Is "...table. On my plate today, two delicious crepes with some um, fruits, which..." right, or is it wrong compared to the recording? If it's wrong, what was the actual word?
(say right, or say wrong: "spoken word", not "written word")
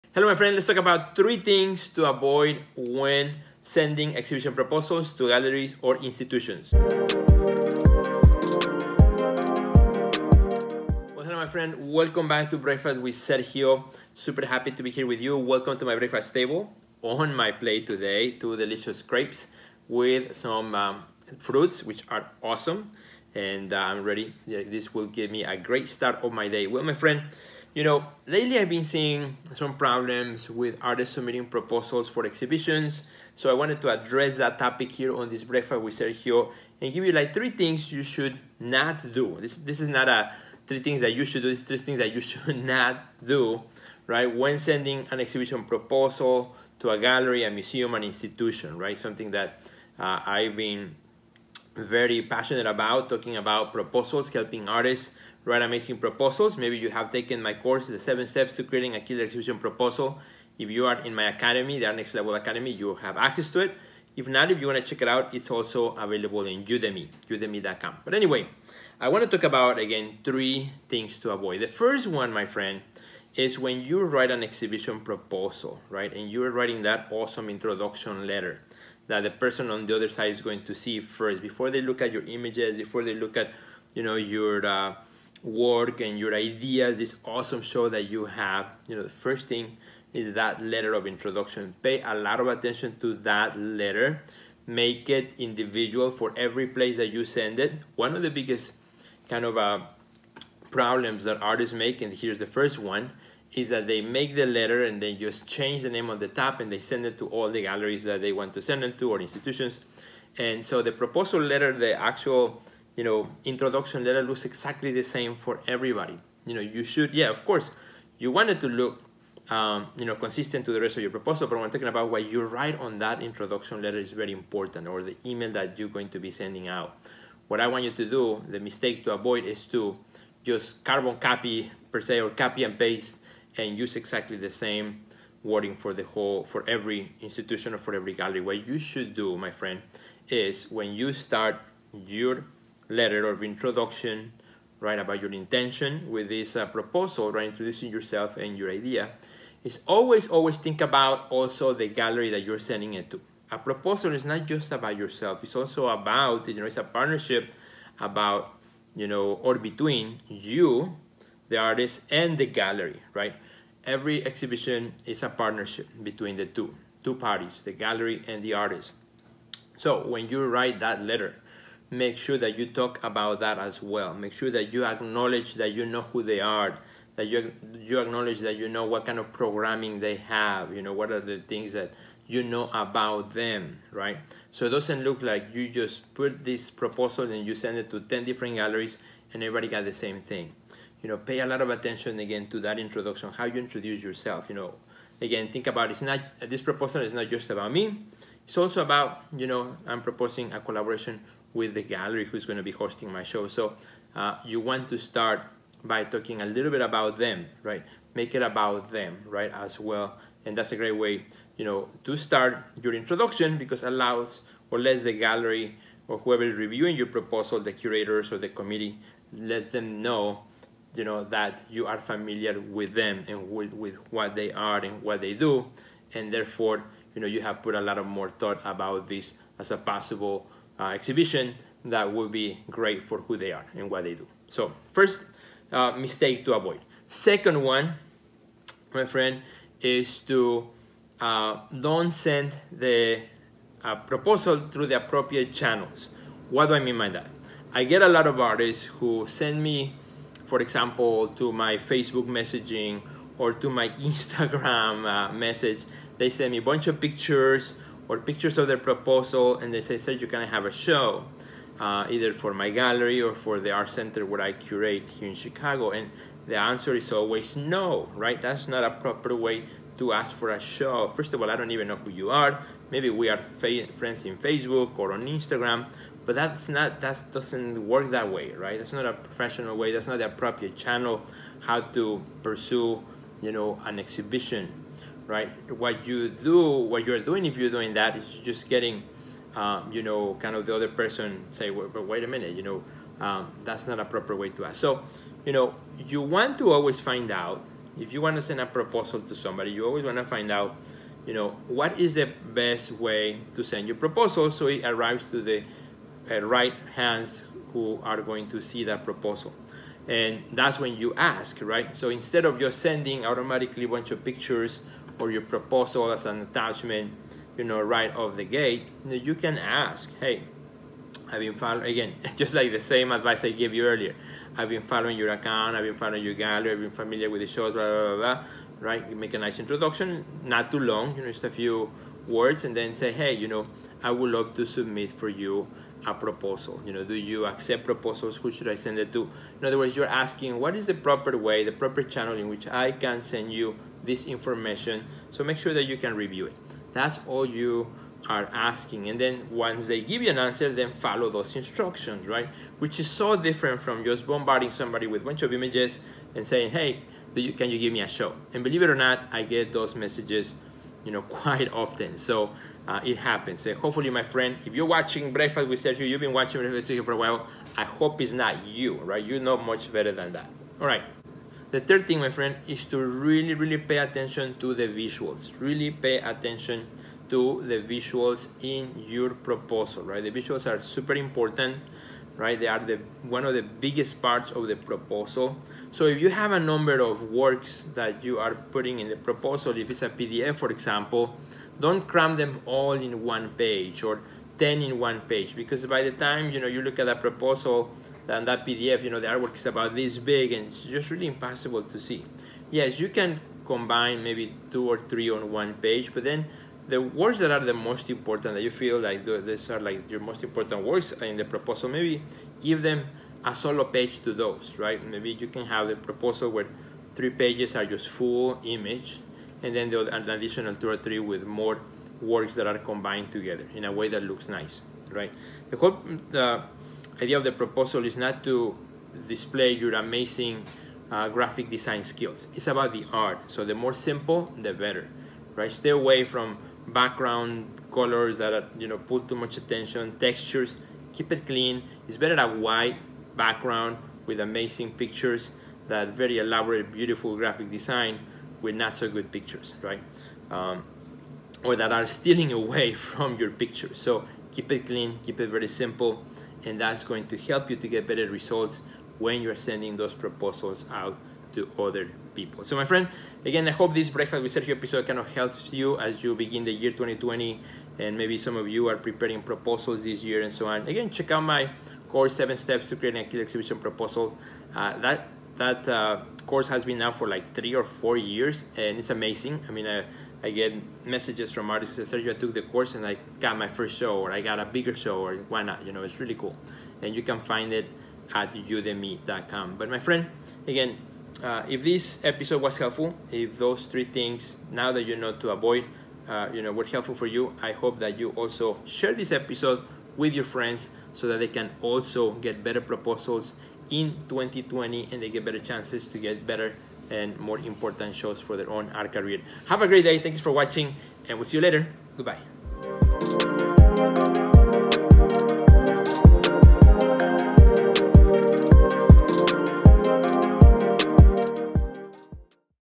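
right.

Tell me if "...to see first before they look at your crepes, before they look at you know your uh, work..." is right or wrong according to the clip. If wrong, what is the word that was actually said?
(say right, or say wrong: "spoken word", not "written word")
wrong: "images", not "crepes".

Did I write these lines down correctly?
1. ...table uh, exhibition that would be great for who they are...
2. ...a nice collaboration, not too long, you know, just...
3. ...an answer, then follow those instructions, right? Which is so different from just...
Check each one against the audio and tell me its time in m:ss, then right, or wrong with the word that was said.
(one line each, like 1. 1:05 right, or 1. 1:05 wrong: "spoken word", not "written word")
1. 3:49 wrong: "possible", not "table"
2. 5:29 wrong: "introduction", not "collaboration"
3. 5:50 right.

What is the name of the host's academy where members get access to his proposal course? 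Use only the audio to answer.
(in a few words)
Next Level Academy.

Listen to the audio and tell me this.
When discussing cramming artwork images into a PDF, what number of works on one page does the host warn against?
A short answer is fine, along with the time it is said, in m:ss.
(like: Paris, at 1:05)
10, at 6:34.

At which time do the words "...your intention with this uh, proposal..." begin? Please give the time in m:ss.
2:25.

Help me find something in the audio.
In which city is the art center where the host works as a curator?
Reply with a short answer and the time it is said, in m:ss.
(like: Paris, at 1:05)
Chicago, at 4:25.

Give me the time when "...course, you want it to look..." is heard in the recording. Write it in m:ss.
1:57.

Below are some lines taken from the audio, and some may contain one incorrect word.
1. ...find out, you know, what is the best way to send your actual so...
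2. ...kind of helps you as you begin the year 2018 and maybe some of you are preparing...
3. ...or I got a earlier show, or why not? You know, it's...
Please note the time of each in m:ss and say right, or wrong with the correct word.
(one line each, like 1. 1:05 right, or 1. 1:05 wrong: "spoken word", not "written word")
1. 5:00 wrong: "proposal", not "actual"
2. 7:45 wrong: "2020", not "2018"
3. 8:04 wrong: "bigger", not "earlier".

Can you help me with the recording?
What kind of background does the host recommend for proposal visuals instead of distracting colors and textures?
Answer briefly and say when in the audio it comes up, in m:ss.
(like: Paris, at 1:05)
A white background, at 7:22.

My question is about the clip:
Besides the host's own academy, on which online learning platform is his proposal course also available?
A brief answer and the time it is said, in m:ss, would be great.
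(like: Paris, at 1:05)
Udemy, at 1:06.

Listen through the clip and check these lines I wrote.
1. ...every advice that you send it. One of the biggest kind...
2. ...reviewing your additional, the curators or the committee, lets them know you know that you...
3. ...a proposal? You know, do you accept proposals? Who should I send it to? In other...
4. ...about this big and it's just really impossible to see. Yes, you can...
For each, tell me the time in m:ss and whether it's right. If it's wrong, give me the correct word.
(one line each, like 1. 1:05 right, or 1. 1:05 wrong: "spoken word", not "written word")
1. 1:36 wrong: "place", not "advice"
2. 3:36 wrong: "proposal", not "additional"
3. 5:36 right
4. 6:39 right.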